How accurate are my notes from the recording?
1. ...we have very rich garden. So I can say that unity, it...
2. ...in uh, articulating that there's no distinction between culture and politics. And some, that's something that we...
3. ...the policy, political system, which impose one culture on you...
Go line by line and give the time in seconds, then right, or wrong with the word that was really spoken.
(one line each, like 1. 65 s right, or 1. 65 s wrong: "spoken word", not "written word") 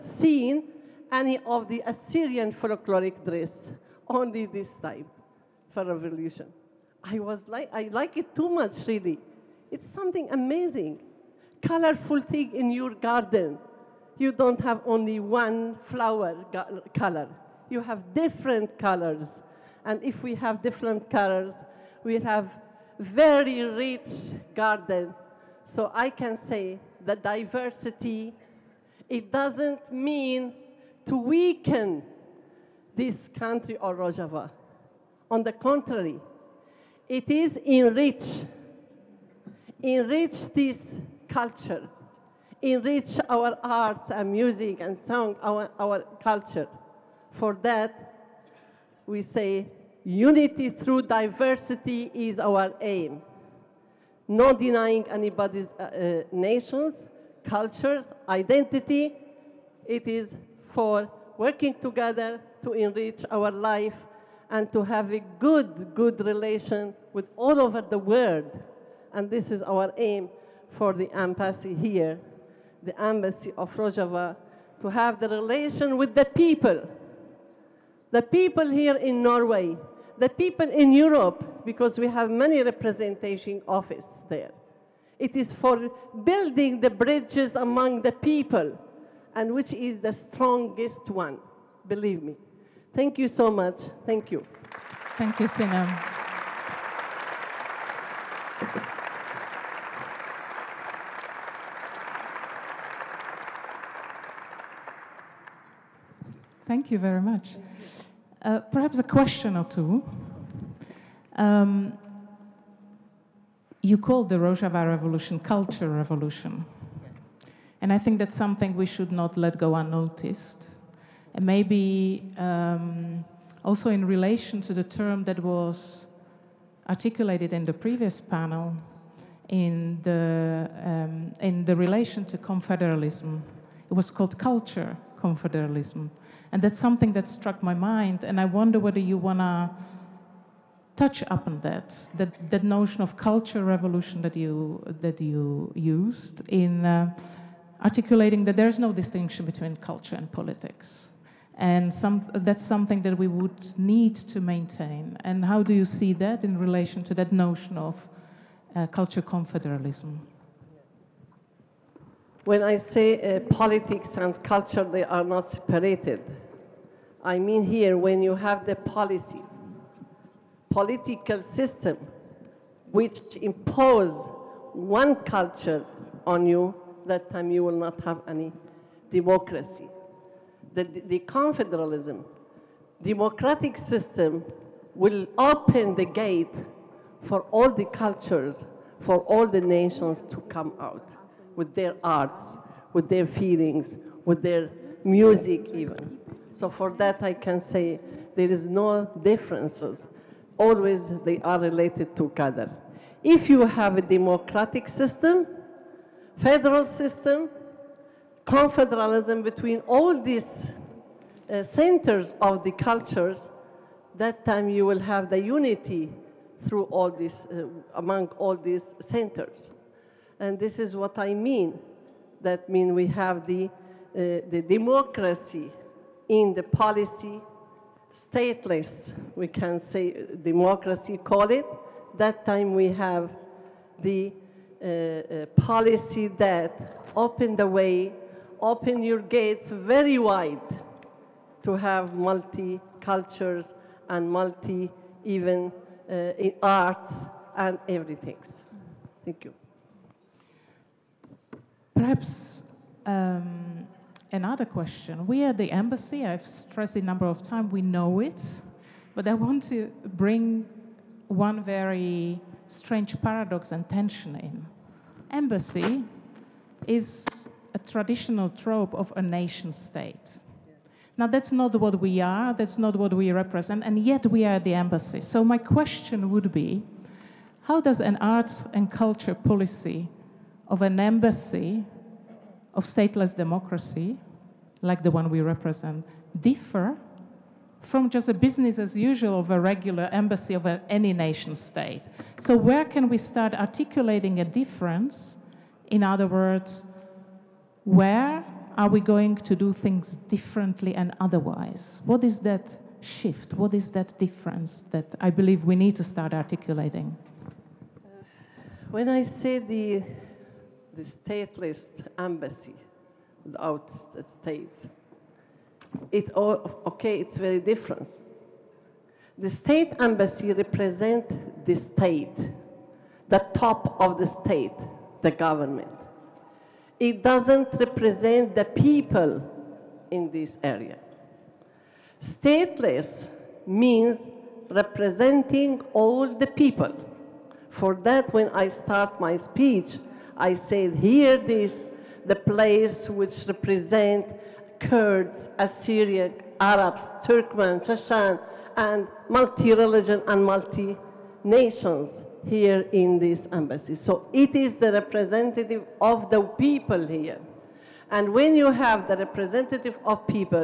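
1. 22 s wrong: "diversity", not "unity"
2. 146 s right
3. 168 s right.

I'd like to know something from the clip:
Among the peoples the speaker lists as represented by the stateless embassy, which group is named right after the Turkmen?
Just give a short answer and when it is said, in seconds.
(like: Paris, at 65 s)
Chechen, at 347 s.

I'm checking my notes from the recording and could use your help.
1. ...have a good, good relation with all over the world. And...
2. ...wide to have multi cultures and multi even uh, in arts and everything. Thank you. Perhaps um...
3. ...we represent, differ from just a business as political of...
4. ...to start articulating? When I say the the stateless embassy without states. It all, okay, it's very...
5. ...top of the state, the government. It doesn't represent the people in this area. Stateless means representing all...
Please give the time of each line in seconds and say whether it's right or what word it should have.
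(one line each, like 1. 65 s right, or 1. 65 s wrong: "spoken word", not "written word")
1. 64 s right
2. 240 s right
3. 285 s wrong: "usual", not "political"
4. 305 s right
5. 323 s right.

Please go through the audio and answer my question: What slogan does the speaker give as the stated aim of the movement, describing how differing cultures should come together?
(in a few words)
Unity through diversity.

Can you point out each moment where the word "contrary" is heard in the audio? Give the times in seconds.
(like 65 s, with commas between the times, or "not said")
35 s.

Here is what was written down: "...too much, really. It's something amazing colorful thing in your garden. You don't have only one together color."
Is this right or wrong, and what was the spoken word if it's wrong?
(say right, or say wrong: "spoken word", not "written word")
wrong: "flower", not "together".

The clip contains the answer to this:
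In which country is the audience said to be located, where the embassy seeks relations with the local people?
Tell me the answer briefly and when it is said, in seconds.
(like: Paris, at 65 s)
Norway, at 79 s.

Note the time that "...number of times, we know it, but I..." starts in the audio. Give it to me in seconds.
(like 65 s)
257 s.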